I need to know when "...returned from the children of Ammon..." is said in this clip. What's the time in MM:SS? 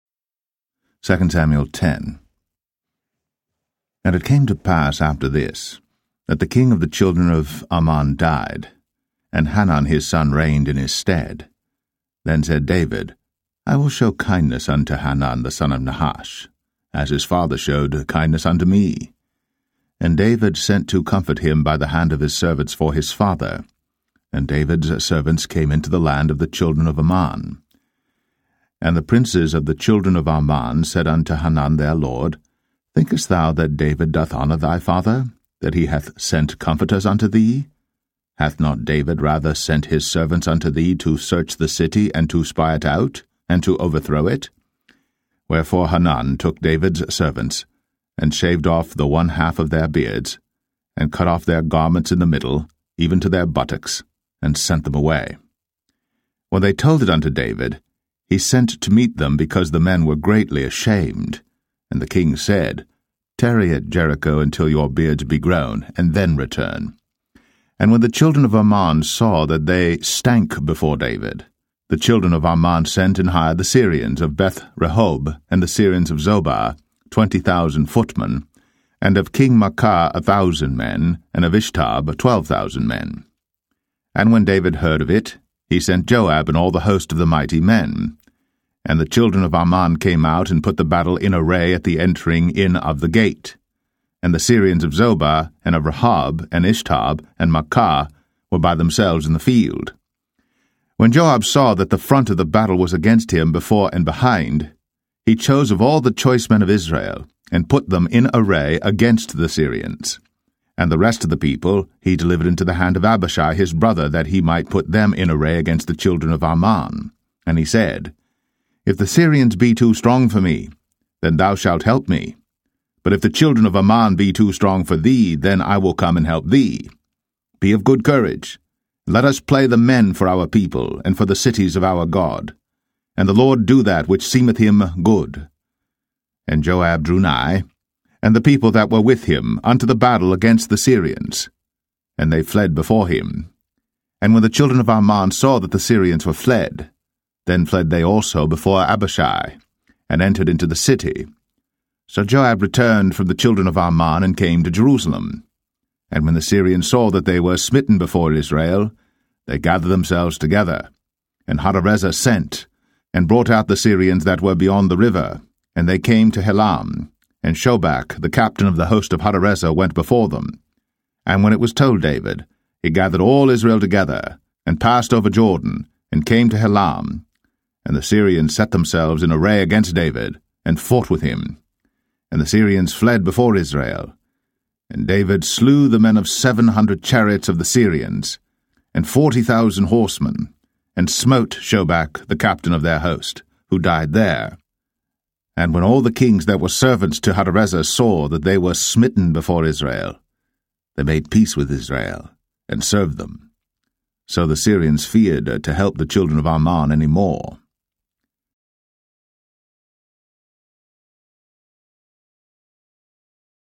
02:32.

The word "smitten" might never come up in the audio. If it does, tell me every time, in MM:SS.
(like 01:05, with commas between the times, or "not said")
02:37, 03:18.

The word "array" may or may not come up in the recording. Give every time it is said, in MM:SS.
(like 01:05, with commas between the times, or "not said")
01:31, 01:48, 01:55, 02:59.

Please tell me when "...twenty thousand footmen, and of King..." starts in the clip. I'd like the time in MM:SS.
01:17.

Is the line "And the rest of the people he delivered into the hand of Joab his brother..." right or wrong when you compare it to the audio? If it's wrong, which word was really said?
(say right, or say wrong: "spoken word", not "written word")
wrong: "Abishai", not "Joab".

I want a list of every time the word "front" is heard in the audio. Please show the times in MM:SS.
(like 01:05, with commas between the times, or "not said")
01:41.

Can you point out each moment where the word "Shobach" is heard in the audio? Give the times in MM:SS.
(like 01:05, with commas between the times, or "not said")
02:47, 03:11.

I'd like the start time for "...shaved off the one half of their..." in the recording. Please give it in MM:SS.
00:48.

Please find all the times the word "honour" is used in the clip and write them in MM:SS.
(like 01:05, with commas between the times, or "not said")
00:34.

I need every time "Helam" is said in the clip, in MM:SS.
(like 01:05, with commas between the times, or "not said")
02:46, 02:56.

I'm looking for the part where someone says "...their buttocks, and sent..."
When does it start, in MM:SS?
00:53.